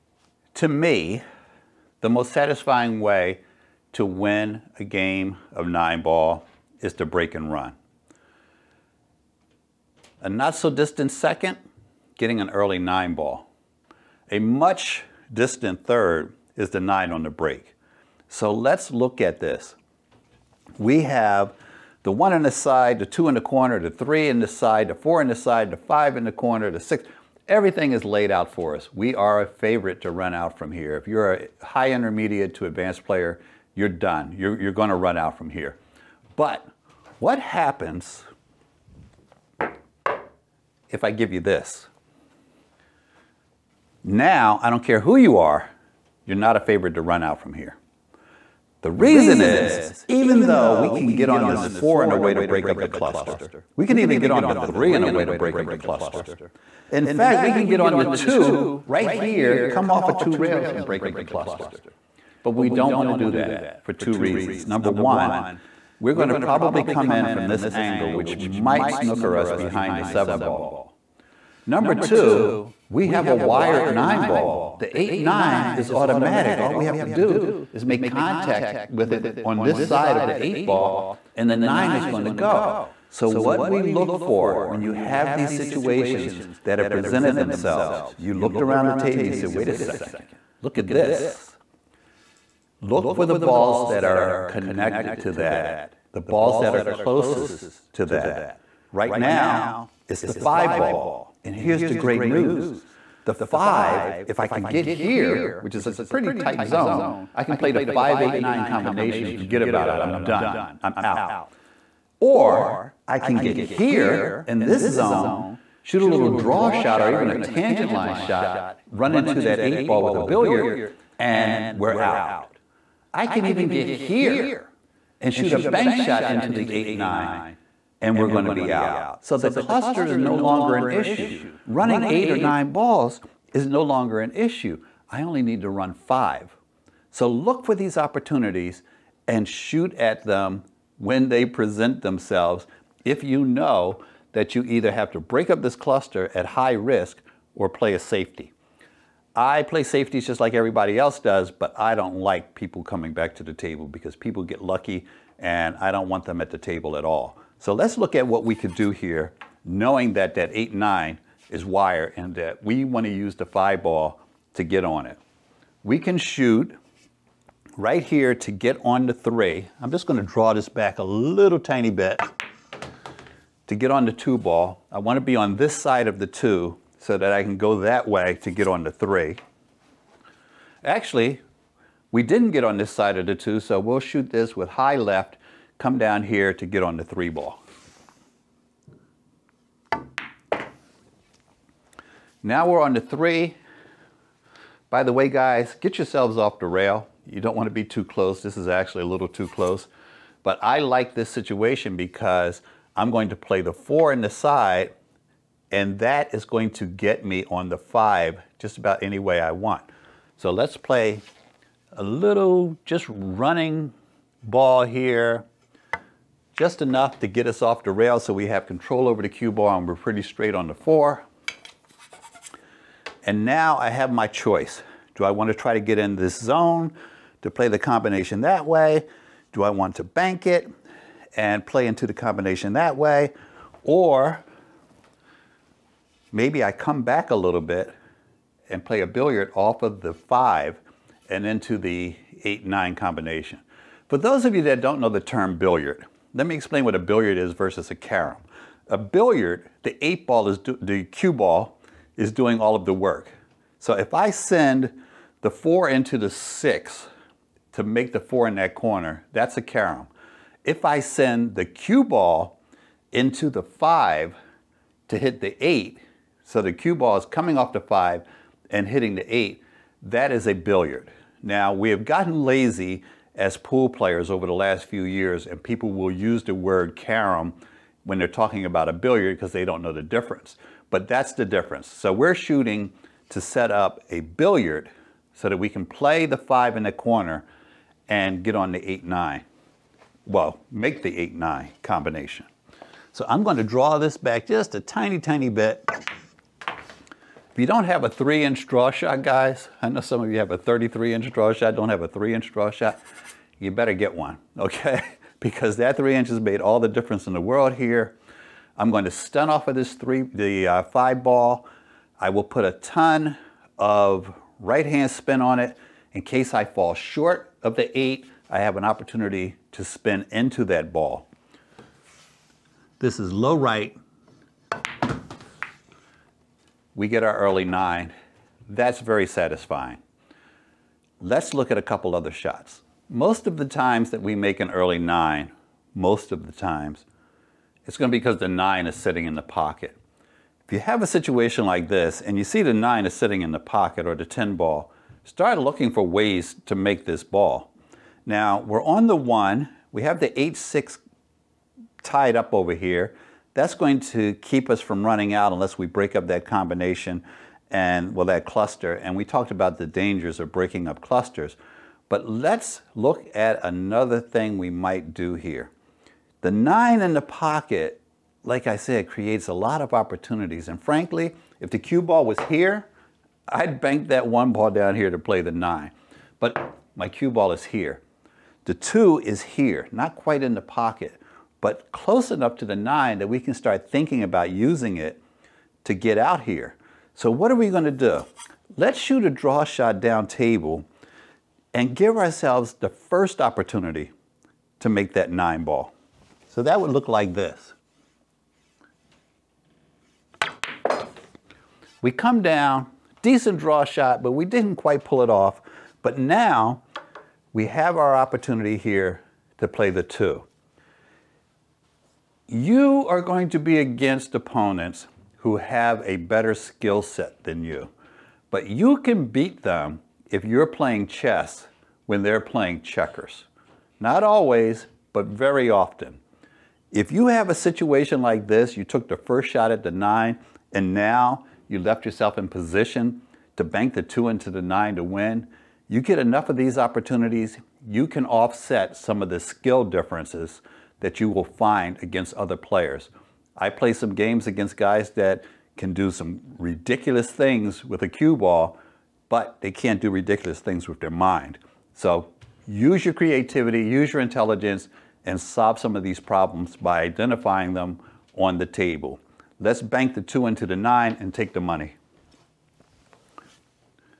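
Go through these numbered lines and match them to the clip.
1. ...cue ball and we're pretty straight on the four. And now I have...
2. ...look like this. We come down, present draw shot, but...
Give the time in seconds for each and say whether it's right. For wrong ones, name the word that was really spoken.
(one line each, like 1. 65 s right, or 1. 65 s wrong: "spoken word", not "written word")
1. 219 s right
2. 396 s wrong: "decent", not "present".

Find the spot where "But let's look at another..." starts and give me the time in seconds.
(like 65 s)
362 s.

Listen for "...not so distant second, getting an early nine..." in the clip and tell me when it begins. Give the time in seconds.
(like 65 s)
10 s.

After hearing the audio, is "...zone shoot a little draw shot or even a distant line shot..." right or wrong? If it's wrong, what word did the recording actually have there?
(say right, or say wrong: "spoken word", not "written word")
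wrong: "tangent", not "distant".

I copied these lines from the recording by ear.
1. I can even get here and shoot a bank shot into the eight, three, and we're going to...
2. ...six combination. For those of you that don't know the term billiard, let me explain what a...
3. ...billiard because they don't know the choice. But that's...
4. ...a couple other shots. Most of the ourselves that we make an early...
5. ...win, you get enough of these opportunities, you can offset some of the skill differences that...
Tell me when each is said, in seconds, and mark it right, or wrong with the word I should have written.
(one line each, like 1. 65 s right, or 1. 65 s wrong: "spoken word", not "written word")
1. 123 s wrong: "nine", not "three"
2. 242 s wrong: "nine", not "six"
3. 278 s wrong: "difference", not "choice"
4. 331 s wrong: "times", not "ourselves"
5. 435 s right.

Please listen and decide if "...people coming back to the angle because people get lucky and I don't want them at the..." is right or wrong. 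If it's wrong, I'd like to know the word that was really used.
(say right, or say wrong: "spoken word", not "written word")
wrong: "table", not "angle".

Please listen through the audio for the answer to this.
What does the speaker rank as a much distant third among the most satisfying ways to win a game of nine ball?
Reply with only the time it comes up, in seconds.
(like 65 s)
16 s.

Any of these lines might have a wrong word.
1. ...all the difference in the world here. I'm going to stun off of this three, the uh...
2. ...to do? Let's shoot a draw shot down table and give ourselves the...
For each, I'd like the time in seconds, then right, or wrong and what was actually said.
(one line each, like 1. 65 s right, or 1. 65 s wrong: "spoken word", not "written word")
1. 306 s right
2. 387 s right.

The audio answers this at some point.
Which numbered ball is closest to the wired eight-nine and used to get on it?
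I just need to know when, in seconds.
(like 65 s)
100 s.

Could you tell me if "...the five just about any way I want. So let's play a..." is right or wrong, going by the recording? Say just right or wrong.
right.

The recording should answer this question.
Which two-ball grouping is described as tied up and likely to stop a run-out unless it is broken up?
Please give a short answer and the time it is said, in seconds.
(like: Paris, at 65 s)
The 8-6, at 350 s.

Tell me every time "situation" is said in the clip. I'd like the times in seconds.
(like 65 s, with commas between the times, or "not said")
85 s, 201 s, 341 s, 427 s.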